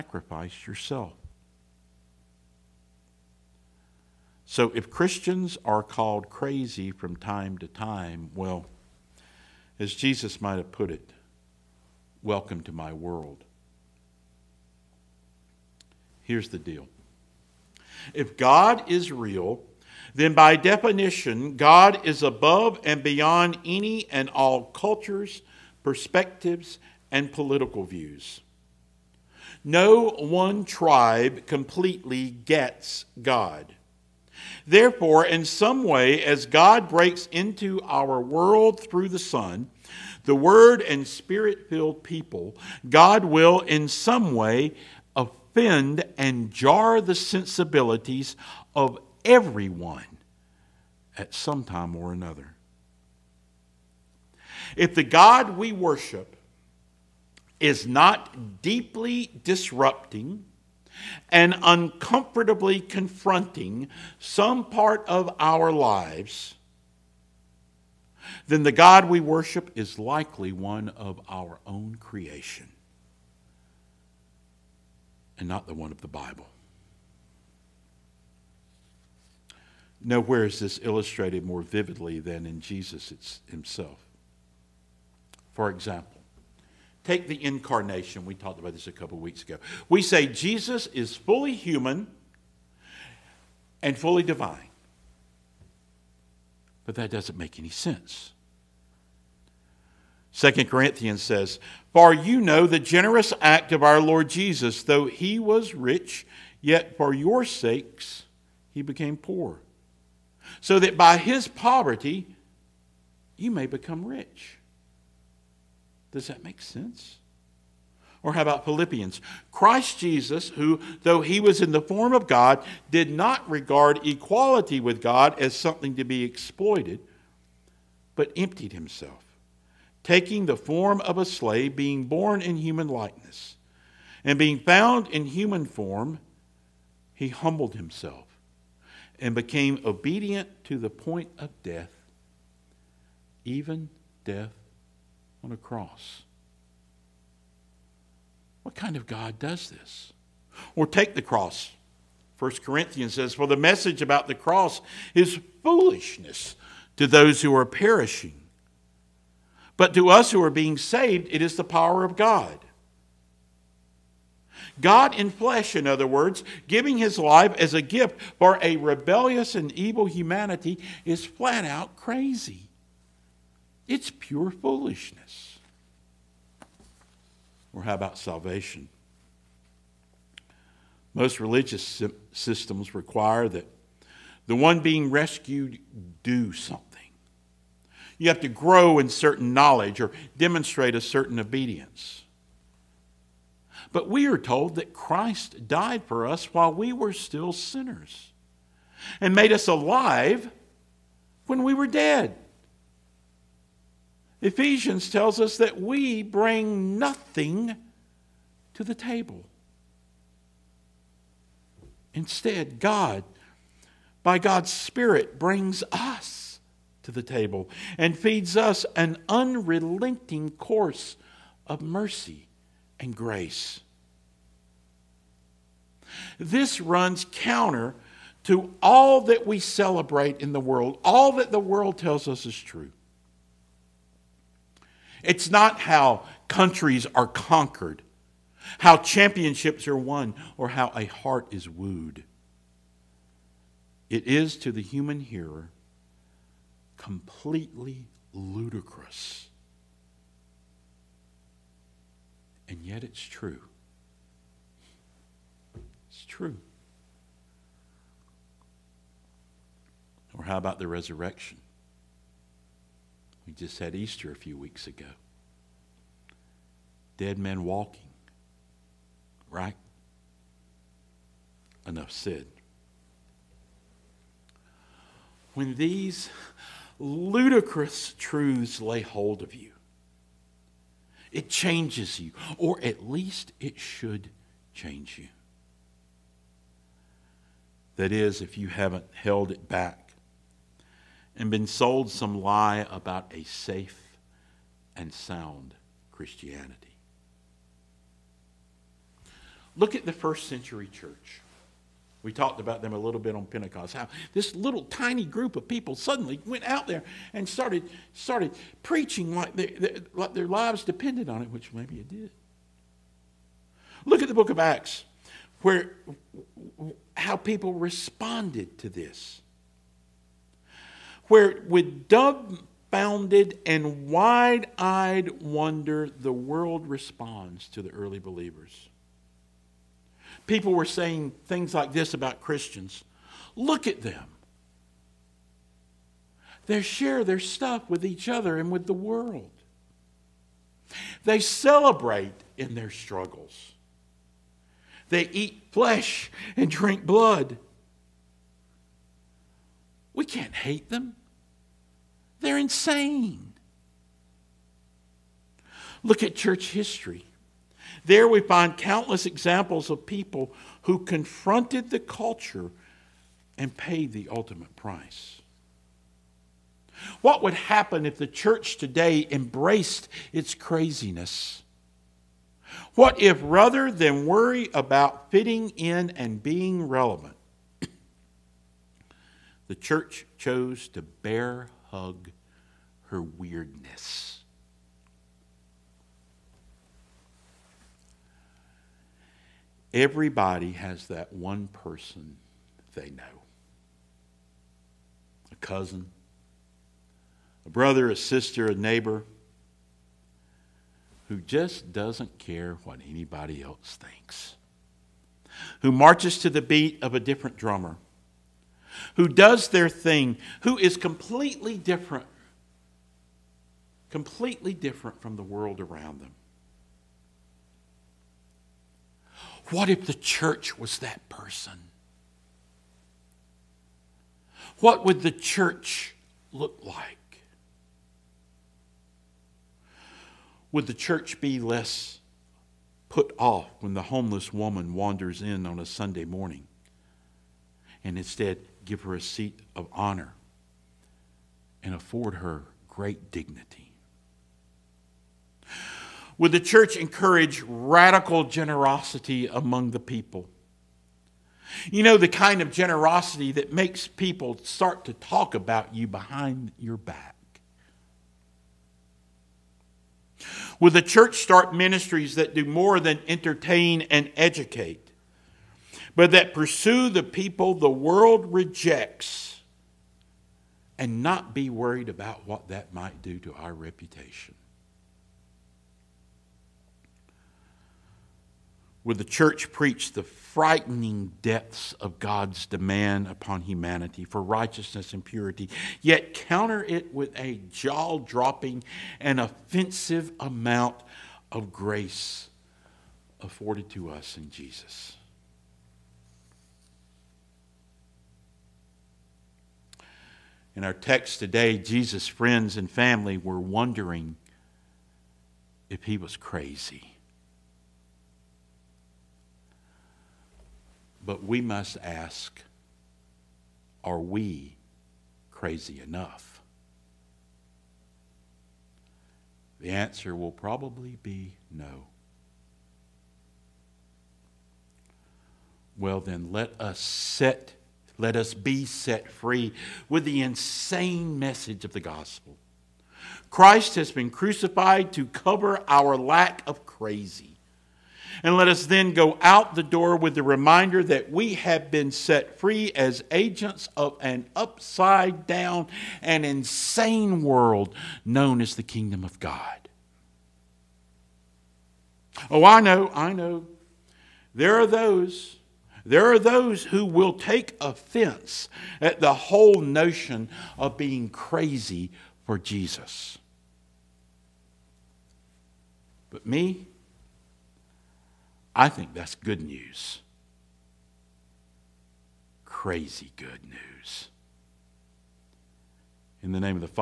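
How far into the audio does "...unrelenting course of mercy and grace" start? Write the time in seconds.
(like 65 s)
219 s.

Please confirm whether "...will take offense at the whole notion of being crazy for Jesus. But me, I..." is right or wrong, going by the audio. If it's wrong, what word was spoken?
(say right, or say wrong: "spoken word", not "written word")
right.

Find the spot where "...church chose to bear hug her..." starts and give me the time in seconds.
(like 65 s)
379 s.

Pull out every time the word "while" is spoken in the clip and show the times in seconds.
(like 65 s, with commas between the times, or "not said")
196 s.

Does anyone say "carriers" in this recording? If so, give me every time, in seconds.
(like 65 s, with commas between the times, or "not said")
not said.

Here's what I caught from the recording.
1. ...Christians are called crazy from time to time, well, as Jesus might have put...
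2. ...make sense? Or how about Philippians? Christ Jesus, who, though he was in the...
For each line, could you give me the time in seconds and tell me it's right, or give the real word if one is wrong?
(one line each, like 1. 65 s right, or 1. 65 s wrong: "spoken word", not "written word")
1. 4 s right
2. 116 s right.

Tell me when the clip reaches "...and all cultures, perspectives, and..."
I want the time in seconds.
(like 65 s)
24 s.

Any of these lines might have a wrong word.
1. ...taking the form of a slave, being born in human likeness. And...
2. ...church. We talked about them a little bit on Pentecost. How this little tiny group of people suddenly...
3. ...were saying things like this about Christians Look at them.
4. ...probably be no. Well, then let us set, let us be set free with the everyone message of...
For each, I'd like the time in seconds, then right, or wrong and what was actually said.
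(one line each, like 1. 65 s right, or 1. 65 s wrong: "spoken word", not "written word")
1. 130 s right
2. 300 s right
3. 330 s right
4. 520 s wrong: "insane", not "everyone".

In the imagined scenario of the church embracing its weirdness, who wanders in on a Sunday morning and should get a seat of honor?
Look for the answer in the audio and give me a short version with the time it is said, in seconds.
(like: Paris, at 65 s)
homeless woman, at 434 s.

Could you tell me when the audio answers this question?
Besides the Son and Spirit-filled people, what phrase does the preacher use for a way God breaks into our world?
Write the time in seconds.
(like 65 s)
40 s.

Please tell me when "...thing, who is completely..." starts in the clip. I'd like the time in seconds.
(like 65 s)
409 s.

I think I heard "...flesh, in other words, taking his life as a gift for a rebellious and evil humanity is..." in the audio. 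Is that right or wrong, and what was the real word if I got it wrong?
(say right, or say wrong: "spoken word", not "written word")
wrong: "giving", not "taking".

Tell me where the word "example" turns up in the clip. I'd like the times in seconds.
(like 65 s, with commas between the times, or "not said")
85 s, 359 s.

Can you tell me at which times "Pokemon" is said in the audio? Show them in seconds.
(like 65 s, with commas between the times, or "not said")
not said.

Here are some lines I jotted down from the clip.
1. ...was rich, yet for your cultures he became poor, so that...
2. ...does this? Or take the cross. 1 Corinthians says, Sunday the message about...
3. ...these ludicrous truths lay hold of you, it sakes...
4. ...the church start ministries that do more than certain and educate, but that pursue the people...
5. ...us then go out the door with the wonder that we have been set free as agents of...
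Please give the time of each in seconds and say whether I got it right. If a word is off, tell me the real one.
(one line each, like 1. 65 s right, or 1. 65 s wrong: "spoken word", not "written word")
1. 105 s wrong: "sakes", not "cultures"
2. 149 s wrong: "For", not "Sunday"
3. 275 s wrong: "changes", not "sakes"
4. 460 s wrong: "entertain", not "certain"
5. 538 s wrong: "reminder", not "wonder".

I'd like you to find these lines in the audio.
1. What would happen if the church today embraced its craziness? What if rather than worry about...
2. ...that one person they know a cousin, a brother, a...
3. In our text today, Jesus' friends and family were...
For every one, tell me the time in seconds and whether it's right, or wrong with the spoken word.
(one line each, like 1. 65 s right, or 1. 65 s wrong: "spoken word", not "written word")
1. 367 s right
2. 391 s right
3. 500 s right.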